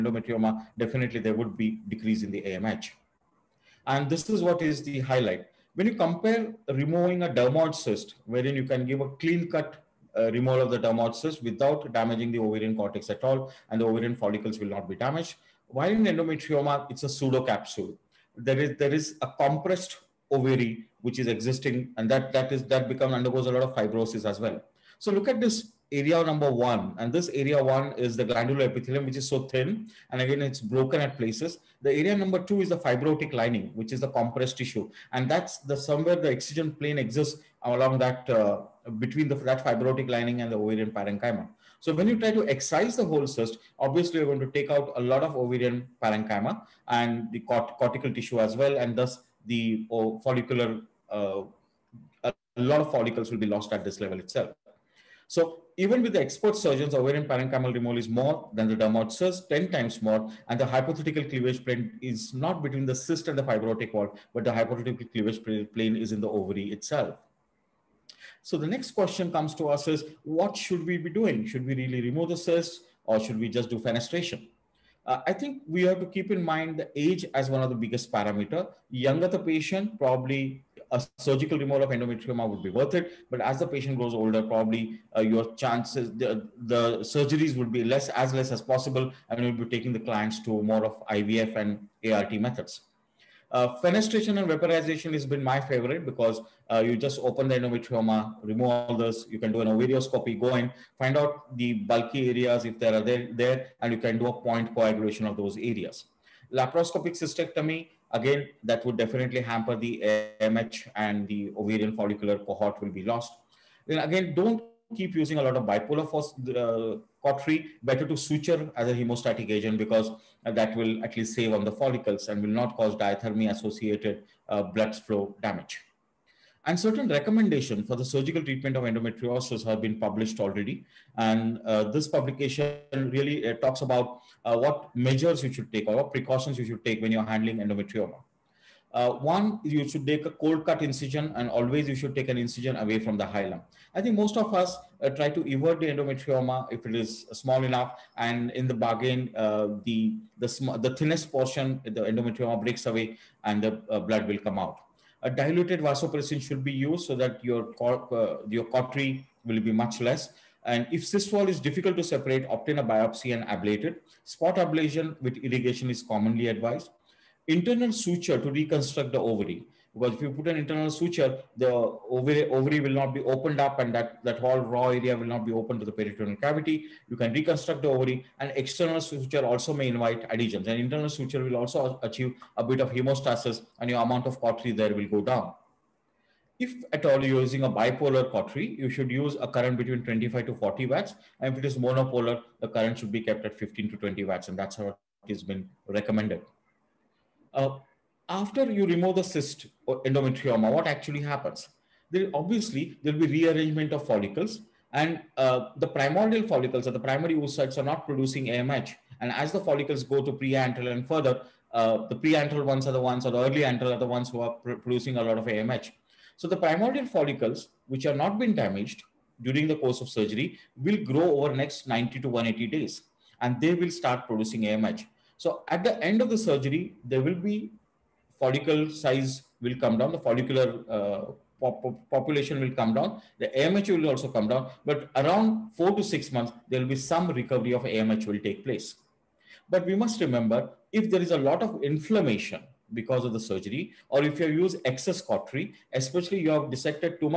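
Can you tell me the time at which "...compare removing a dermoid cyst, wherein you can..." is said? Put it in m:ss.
0:05.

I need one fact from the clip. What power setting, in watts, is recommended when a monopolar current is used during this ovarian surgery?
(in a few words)
15 to 20 watts.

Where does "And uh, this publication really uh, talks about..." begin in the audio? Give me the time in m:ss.
2:11.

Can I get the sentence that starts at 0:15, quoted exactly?
While in endometrioma, it's a pseudocapsule.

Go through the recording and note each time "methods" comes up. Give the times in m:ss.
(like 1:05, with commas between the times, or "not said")
1:32.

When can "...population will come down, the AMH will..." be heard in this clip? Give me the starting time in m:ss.
3:52.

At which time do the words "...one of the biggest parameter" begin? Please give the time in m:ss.
1:17.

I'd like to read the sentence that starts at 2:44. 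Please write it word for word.
Spot ablation with irrigation is commonly advised.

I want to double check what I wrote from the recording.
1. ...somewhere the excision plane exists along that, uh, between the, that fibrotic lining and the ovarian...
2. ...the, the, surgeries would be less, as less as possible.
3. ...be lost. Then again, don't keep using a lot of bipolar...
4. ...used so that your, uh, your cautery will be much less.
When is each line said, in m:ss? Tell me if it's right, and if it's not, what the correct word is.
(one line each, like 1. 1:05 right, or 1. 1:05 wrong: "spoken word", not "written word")
1. 0:35 right
2. 1:26 right
3. 1:52 right
4. 2:36 right.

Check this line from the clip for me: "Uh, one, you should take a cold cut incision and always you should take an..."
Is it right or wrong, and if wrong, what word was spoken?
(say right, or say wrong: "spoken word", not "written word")
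right.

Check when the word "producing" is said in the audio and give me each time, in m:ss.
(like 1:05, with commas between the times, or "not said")
3:28, 3:34, 3:44.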